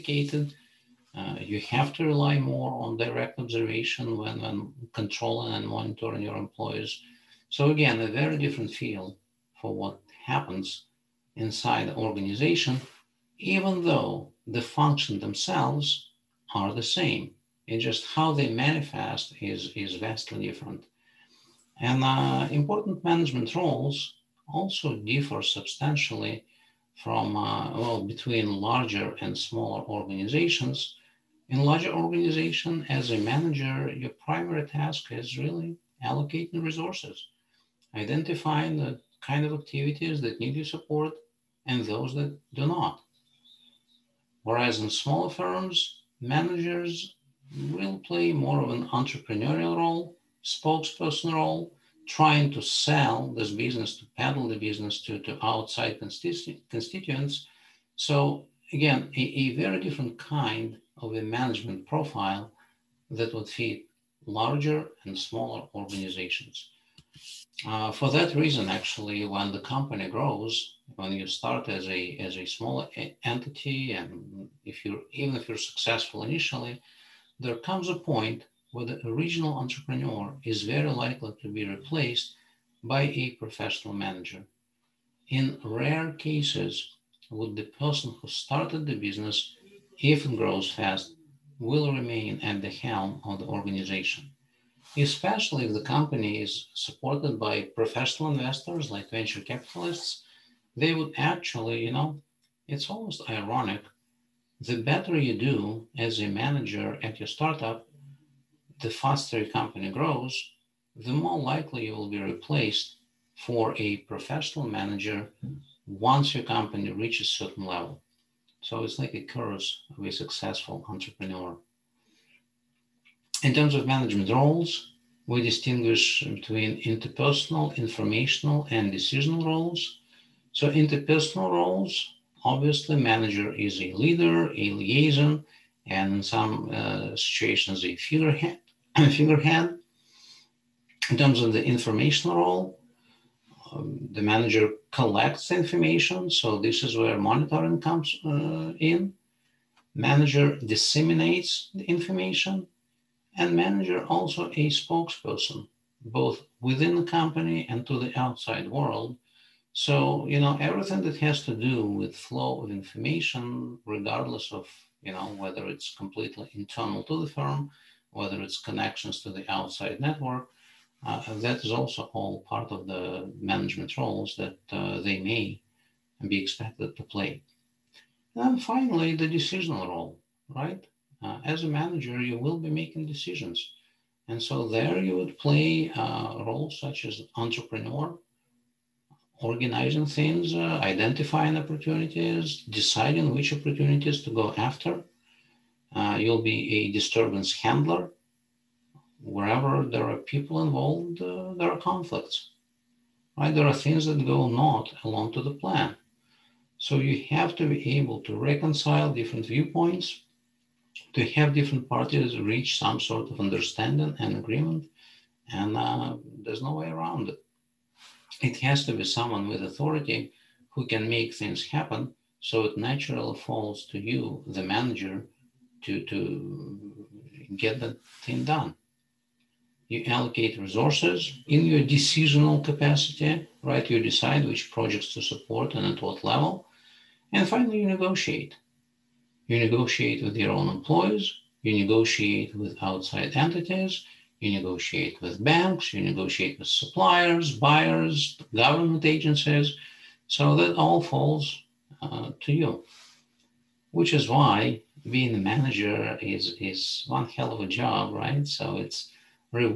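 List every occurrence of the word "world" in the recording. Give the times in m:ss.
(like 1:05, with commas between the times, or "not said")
2:38.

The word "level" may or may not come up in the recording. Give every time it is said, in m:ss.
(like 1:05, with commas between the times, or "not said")
1:57, 3:56.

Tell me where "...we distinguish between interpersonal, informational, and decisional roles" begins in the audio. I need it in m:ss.
2:05.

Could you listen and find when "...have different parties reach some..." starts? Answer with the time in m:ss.
3:31.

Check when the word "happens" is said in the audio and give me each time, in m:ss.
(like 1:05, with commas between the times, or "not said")
0:10, 3:41.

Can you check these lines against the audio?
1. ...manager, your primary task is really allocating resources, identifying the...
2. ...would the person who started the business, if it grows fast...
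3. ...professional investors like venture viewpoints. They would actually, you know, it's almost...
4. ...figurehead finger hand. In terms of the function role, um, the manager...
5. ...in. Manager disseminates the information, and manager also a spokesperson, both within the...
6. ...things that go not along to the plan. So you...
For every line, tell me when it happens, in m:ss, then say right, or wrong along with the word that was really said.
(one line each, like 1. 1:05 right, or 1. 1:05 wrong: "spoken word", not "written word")
1. 0:33 right
2. 1:27 right
3. 1:37 wrong: "capitalists", not "viewpoints"
4. 2:17 wrong: "information", not "function"
5. 2:28 right
6. 3:23 right.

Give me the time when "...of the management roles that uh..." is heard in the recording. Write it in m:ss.
2:52.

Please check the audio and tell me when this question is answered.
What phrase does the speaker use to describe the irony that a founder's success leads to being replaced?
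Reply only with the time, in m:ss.
1:59.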